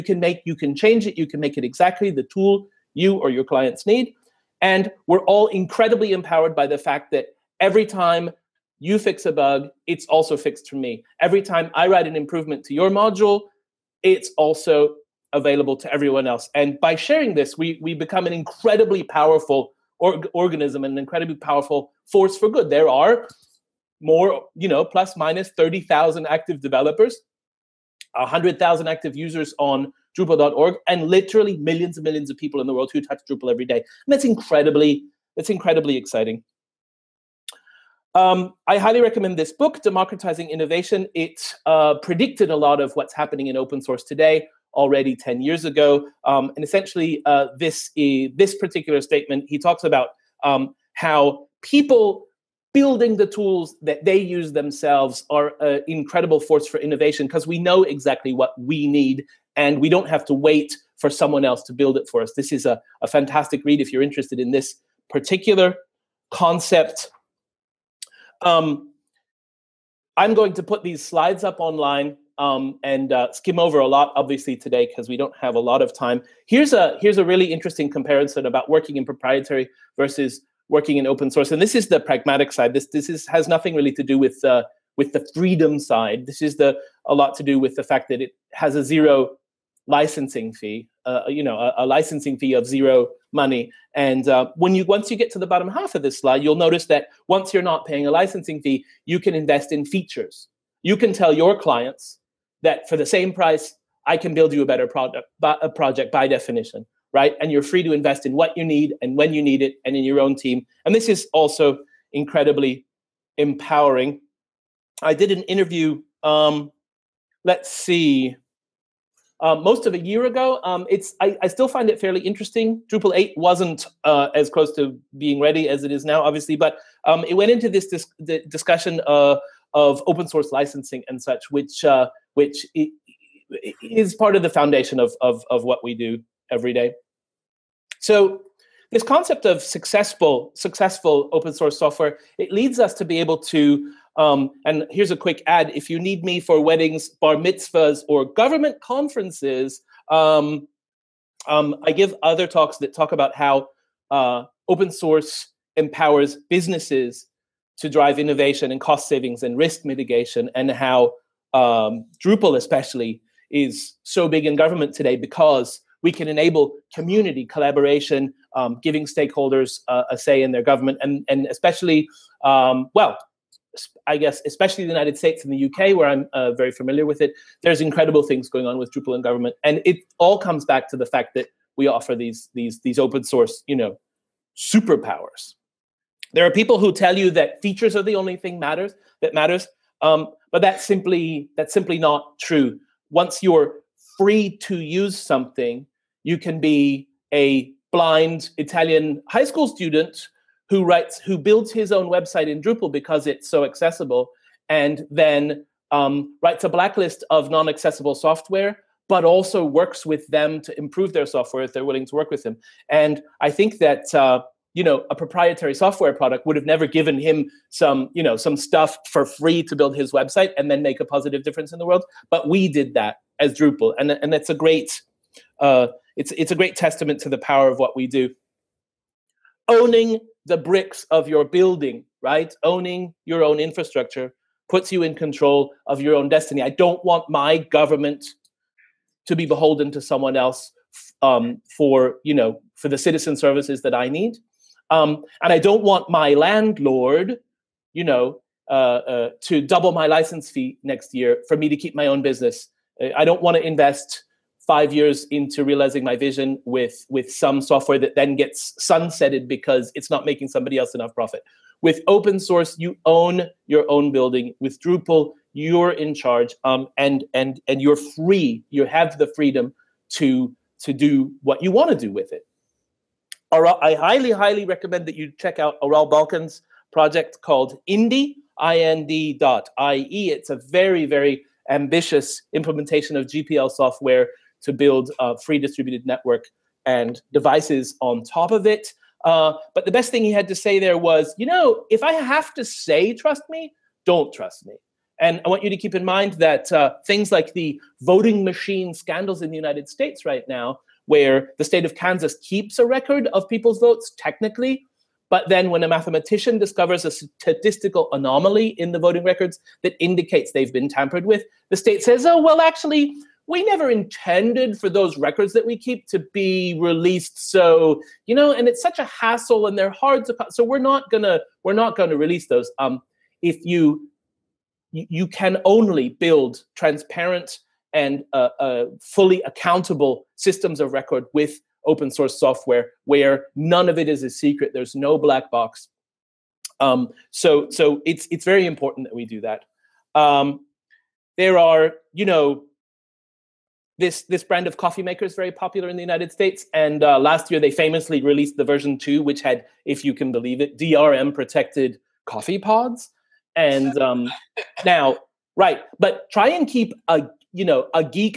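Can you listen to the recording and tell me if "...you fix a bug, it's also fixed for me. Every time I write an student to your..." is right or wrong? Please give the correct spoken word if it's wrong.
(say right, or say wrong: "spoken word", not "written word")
wrong: "improvement", not "student".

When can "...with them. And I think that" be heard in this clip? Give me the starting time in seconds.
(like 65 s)
212 s.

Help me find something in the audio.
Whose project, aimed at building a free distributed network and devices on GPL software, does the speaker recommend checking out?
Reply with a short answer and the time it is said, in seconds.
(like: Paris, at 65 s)
Aral Balkan, at 275 s.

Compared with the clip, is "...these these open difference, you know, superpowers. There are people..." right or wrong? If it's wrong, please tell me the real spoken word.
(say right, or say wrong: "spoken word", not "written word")
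wrong: "source", not "difference".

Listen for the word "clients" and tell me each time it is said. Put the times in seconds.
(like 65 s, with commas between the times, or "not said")
3 s, 101 s.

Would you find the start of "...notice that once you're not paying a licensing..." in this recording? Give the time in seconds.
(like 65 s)
96 s.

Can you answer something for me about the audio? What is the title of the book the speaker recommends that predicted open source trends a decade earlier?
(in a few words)
Democratizing Innovation.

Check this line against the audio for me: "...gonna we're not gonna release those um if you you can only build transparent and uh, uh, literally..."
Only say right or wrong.
wrong.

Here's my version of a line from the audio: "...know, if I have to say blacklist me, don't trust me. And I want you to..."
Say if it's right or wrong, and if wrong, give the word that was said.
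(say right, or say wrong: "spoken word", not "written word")
wrong: "trust", not "blacklist".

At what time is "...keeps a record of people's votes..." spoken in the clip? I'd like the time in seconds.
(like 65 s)
302 s.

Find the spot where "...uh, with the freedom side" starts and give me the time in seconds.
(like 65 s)
84 s.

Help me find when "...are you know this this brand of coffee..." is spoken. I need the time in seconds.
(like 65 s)
341 s.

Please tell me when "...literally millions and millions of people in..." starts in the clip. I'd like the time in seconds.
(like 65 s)
31 s.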